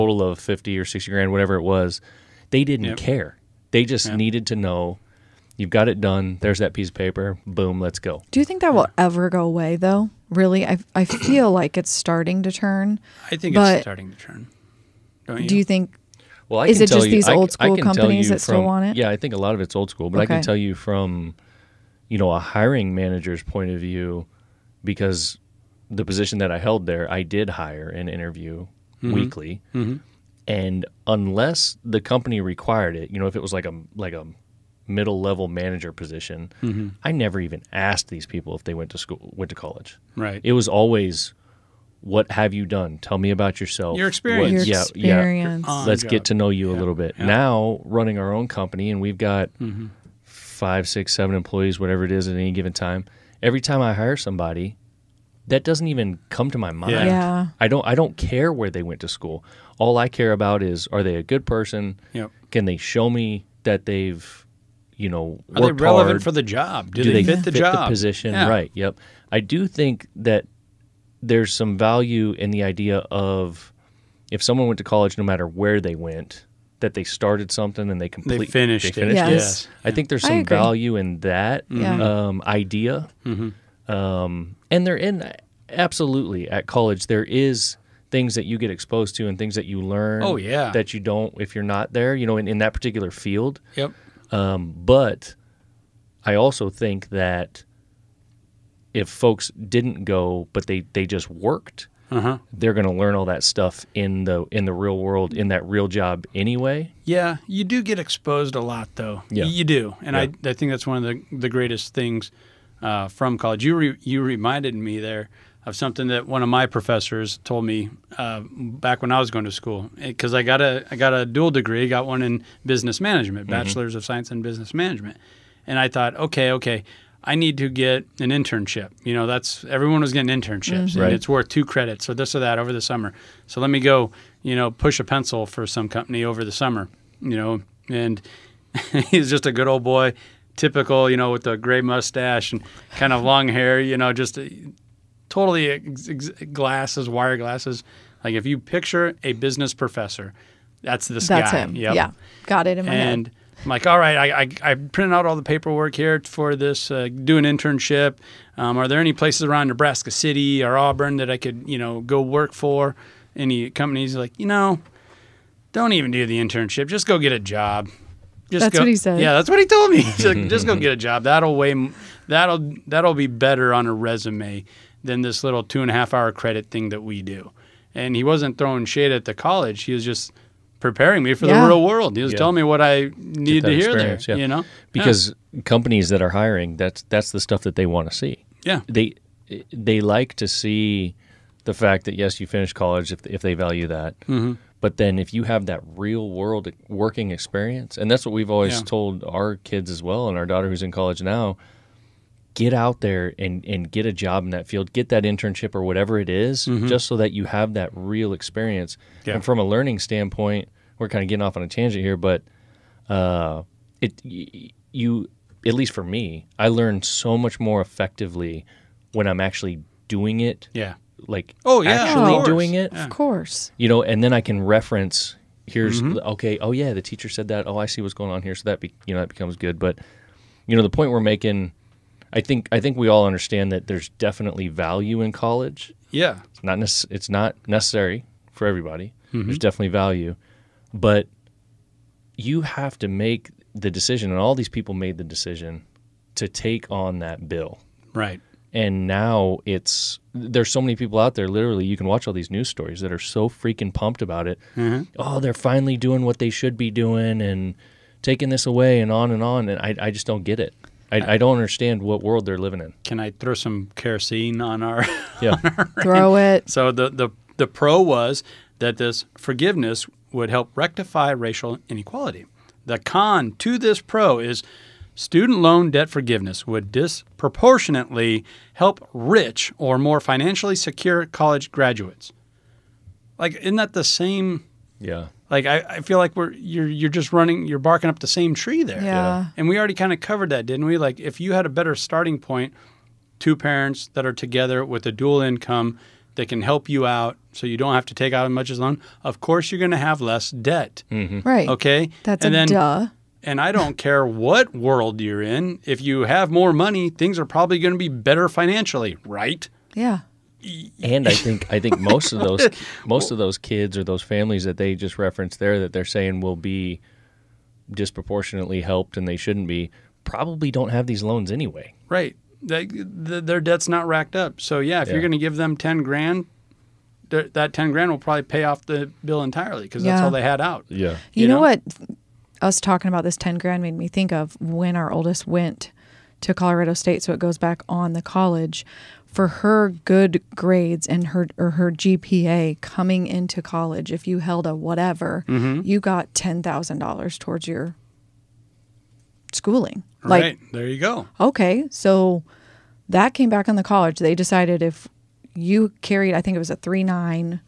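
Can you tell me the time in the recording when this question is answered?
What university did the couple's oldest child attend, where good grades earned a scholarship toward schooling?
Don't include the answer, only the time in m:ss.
5:36.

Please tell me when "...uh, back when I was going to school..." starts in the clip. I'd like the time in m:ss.
1:58.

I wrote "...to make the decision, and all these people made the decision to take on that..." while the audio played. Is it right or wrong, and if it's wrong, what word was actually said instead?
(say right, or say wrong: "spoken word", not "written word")
right.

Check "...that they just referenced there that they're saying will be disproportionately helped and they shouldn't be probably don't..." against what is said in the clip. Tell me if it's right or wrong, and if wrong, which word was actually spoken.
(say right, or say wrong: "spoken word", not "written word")
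right.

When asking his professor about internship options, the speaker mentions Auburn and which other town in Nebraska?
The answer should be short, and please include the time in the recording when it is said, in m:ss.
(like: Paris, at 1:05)
Nebraska City, at 2:39.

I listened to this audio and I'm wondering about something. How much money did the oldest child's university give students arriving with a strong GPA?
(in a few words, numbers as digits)
$10,000.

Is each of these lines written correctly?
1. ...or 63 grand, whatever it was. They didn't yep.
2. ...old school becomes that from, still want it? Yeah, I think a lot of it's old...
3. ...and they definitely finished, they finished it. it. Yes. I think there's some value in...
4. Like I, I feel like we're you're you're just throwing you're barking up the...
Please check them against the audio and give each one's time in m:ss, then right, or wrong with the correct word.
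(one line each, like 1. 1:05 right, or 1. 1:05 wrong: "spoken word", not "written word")
1. 0:00 wrong: "60", not "63"
2. 0:17 wrong: "companies", not "becomes"
3. 1:17 wrong: "completely", not "definitely"
4. 4:45 wrong: "running", not "throwing".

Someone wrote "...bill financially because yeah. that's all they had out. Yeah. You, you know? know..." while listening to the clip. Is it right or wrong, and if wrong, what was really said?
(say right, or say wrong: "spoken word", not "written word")
wrong: "entirely", not "financially".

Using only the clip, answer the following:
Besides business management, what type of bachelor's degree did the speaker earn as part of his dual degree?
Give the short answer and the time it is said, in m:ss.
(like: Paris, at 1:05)
Bachelor's of science, at 2:03.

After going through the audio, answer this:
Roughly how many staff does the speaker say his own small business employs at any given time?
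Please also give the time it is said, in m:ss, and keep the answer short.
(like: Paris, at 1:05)
5, 6, 7, at 0:50.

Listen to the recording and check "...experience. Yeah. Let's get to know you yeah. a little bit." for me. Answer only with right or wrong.
right.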